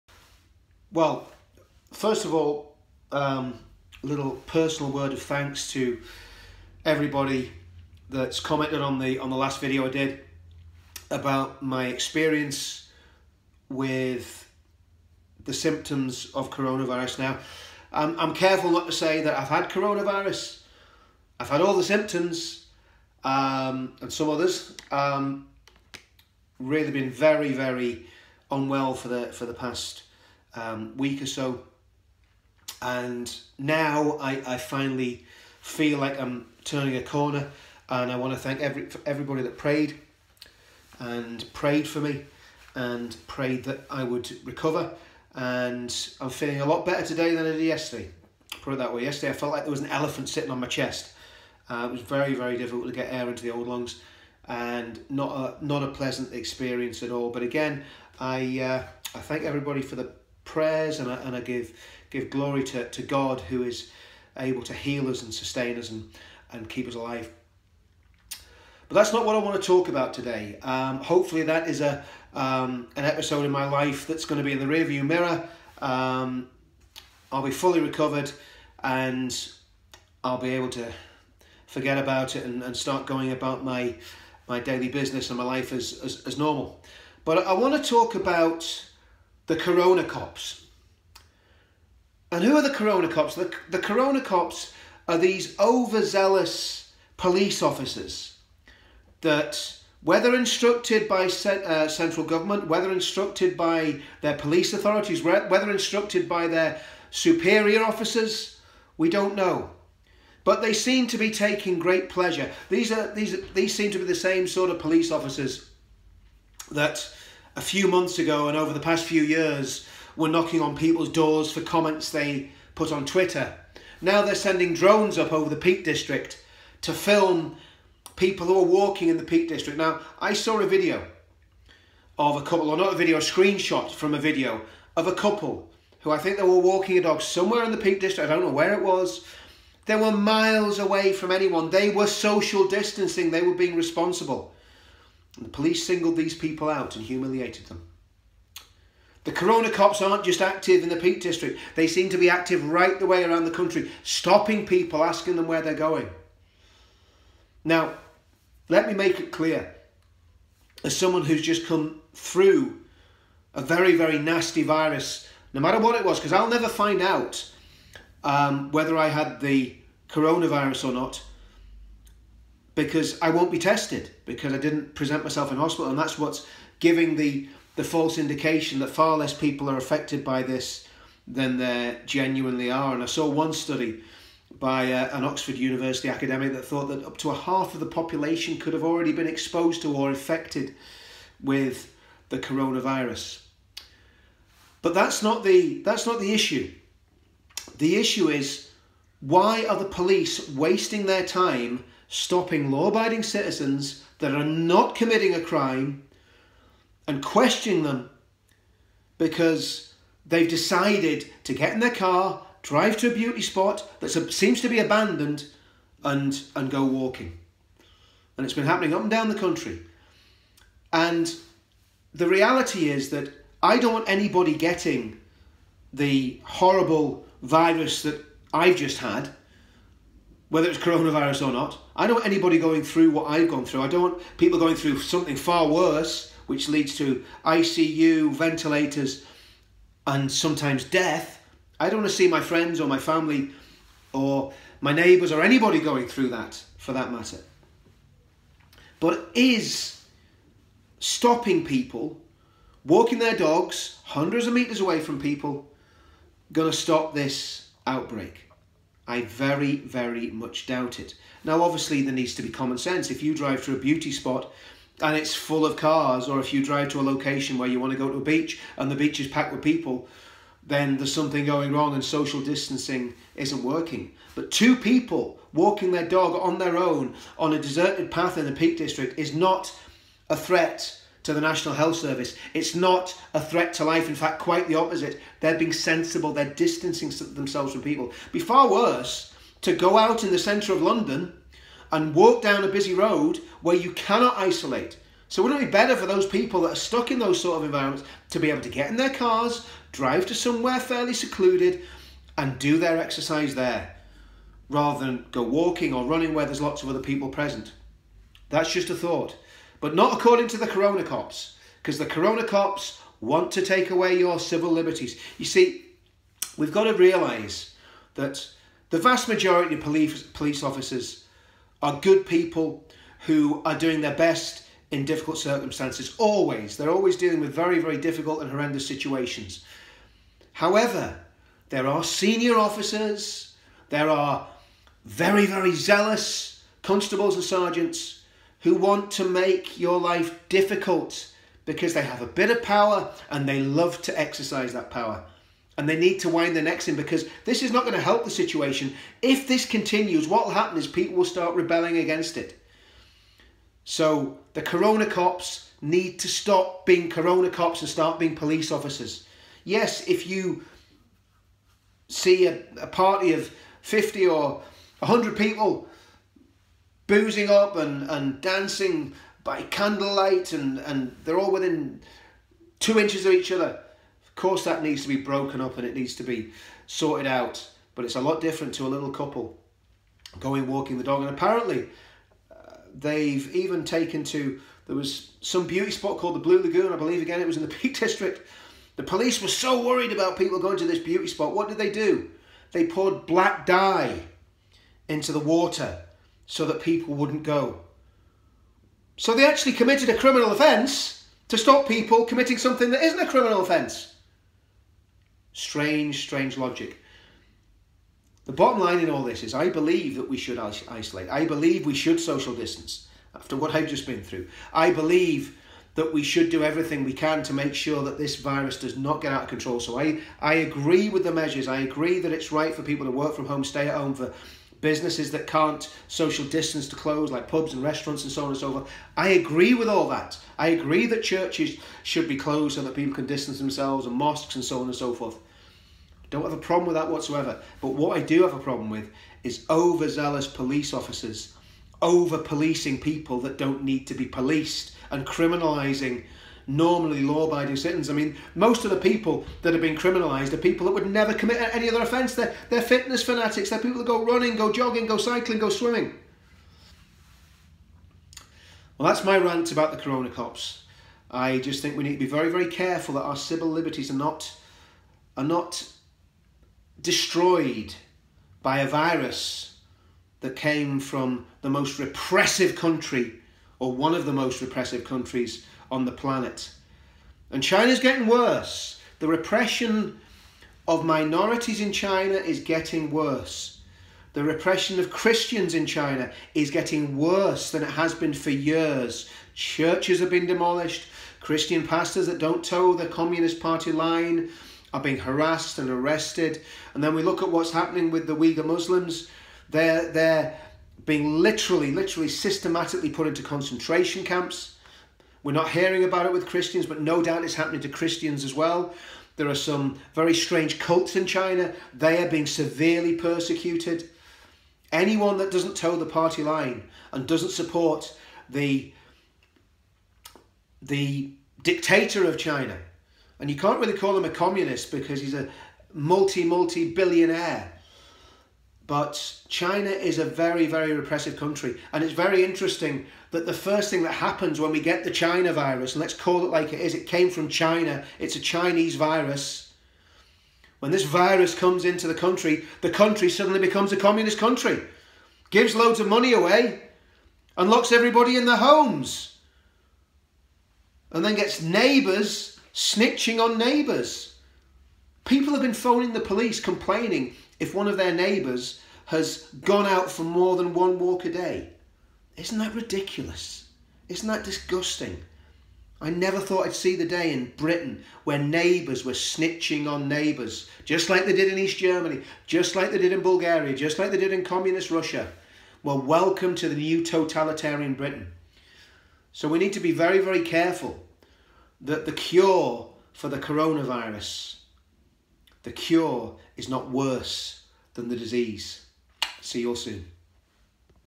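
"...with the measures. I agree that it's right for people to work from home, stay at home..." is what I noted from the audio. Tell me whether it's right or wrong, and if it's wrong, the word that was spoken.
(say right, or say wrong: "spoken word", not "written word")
right.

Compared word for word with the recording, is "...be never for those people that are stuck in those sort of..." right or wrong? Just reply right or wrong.
wrong.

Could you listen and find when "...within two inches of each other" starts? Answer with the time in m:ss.
6:11.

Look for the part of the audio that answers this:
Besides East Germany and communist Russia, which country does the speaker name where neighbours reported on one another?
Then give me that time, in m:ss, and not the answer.
9:33.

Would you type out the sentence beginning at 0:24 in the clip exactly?
Um, really been very, very unwell for the for the past um, week or so.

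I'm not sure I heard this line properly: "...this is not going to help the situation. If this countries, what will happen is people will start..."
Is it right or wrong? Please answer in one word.
wrong.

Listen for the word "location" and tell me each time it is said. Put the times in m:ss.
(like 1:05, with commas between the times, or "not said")
4:27.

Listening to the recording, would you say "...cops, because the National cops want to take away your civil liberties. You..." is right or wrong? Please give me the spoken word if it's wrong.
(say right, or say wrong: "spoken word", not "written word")
wrong: "Corona", not "National".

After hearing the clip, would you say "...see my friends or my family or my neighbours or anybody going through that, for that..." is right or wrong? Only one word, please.
right.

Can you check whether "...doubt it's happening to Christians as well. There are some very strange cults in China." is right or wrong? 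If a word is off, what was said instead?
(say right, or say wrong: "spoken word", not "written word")
right.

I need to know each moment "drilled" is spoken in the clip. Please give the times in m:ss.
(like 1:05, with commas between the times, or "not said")
not said.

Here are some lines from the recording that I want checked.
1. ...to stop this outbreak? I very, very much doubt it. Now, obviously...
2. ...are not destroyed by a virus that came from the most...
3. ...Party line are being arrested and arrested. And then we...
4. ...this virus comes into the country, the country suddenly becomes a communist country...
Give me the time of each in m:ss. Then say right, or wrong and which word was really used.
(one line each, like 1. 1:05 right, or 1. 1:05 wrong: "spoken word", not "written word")
1. 4:16 right
2. 7:45 right
3. 8:13 wrong: "harassed", not "arrested"
4. 9:00 right.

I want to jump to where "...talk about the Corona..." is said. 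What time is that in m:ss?
1:27.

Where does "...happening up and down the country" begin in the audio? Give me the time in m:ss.
3:38.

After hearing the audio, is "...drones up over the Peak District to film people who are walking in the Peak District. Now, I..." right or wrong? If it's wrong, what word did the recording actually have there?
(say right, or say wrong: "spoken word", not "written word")
right.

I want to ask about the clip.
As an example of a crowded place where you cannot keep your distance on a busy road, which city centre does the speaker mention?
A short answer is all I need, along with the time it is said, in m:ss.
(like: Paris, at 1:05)
London, at 4:50.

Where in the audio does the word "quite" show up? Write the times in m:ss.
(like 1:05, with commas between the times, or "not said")
4:44.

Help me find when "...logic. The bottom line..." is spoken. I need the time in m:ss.
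6:46.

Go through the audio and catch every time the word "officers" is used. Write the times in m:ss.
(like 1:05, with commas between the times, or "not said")
1:37, 1:47, 1:55, 5:20, 5:32, 5:58, 7:20.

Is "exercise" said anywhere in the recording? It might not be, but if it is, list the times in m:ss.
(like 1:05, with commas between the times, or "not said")
5:02, 5:44.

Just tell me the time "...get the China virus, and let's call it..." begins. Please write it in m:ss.
8:54.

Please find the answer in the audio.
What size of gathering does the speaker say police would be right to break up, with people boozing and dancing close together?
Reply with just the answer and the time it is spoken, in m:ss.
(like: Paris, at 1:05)
50 or 100, at 6:03.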